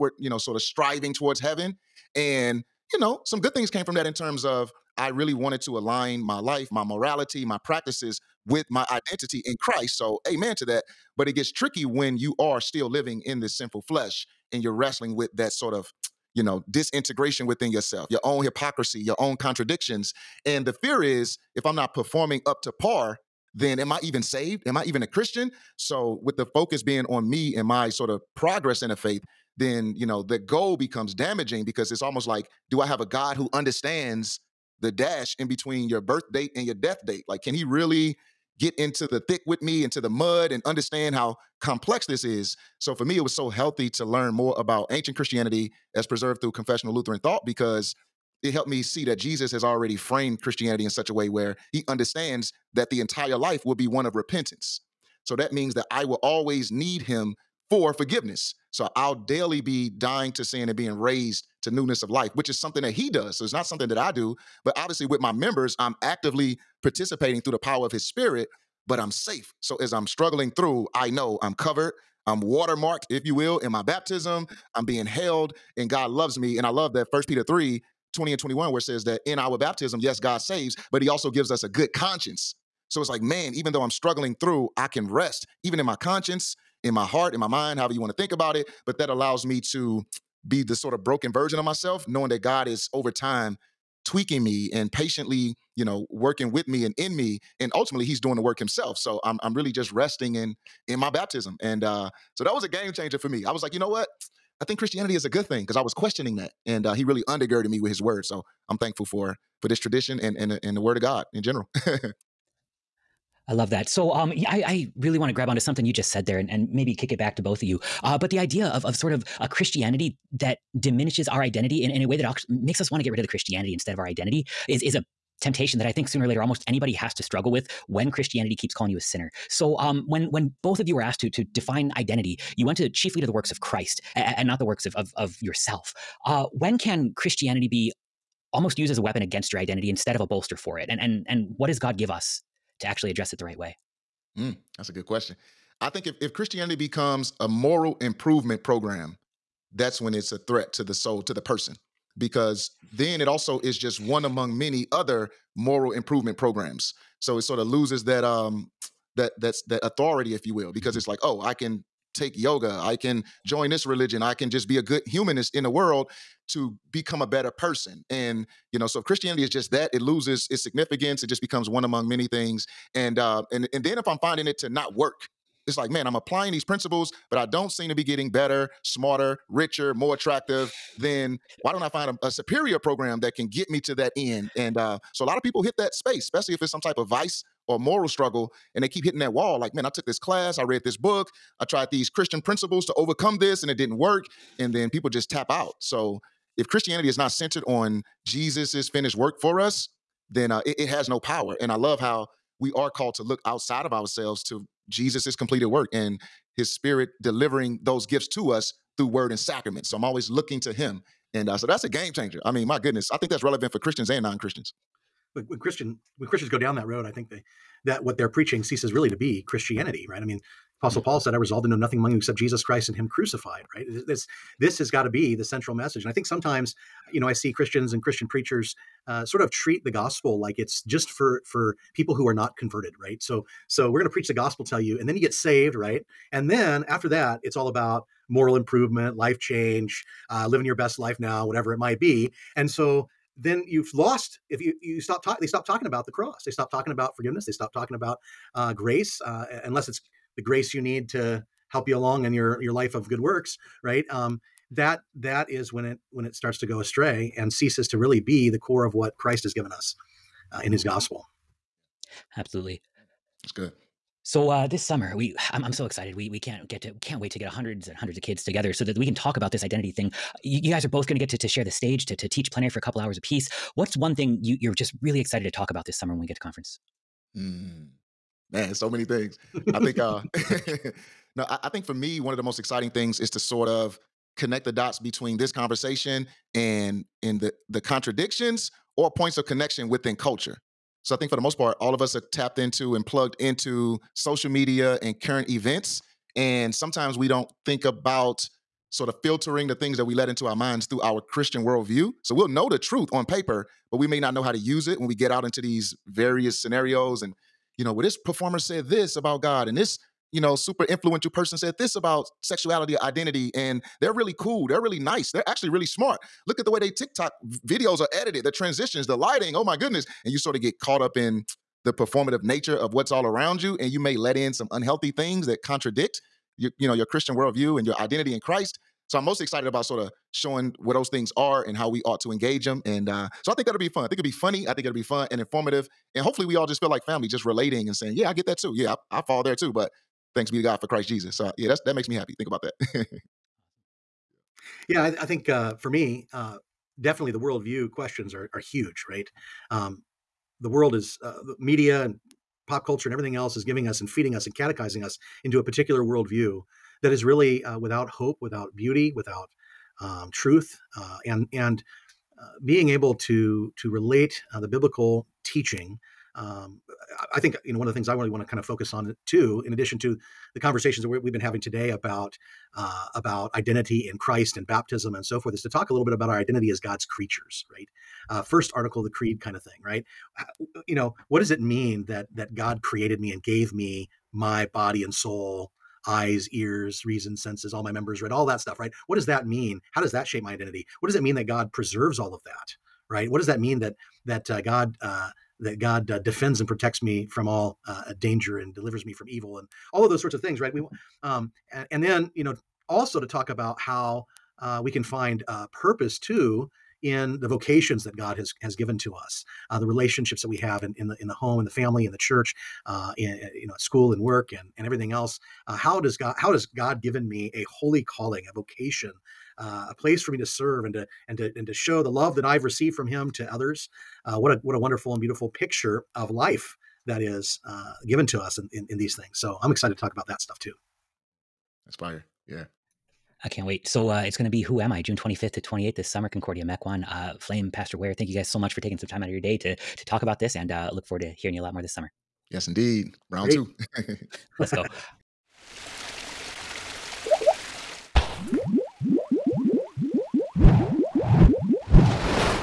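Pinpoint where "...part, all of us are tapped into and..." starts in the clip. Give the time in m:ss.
4:51.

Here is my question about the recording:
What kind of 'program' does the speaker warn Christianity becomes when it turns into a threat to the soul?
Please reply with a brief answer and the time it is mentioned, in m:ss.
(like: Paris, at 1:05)
Moral improvement program, at 2:27.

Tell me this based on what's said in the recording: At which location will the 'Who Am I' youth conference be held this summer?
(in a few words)
Concordia Mequon.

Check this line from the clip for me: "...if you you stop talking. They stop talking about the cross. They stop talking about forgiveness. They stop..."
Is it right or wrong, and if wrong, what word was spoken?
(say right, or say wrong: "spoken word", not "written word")
right.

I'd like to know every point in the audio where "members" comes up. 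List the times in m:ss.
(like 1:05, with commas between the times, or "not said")
1:05, 6:27.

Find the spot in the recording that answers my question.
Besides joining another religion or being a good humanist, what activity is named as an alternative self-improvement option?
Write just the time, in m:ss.
2:42.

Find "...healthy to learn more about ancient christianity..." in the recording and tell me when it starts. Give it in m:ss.
0:43.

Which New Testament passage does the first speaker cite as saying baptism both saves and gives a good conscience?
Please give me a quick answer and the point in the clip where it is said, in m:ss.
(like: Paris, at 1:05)
1 Peter 3:20-21, at 1:17.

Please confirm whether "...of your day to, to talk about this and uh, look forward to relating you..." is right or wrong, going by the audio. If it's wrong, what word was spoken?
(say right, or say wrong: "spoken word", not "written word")
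wrong: "hearing", not "relating".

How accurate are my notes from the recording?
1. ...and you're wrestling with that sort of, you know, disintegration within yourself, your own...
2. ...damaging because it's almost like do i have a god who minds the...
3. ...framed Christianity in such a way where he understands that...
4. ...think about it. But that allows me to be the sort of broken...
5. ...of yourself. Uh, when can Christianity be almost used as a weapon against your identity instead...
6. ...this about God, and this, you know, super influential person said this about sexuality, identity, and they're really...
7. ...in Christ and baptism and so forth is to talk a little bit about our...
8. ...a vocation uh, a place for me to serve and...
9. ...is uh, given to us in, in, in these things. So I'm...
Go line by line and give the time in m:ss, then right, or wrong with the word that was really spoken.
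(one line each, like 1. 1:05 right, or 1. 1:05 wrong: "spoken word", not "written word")
1. 0:14 right
2. 0:31 wrong: "understands", not "minds"
3. 0:49 right
4. 1:28 right
5. 2:15 right
6. 5:08 right
7. 6:14 right
8. 6:58 right
9. 7:07 right.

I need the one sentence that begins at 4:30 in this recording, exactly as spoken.
You, you guys are both going to get to share the stage to to teach plenary for a couple hours a piece.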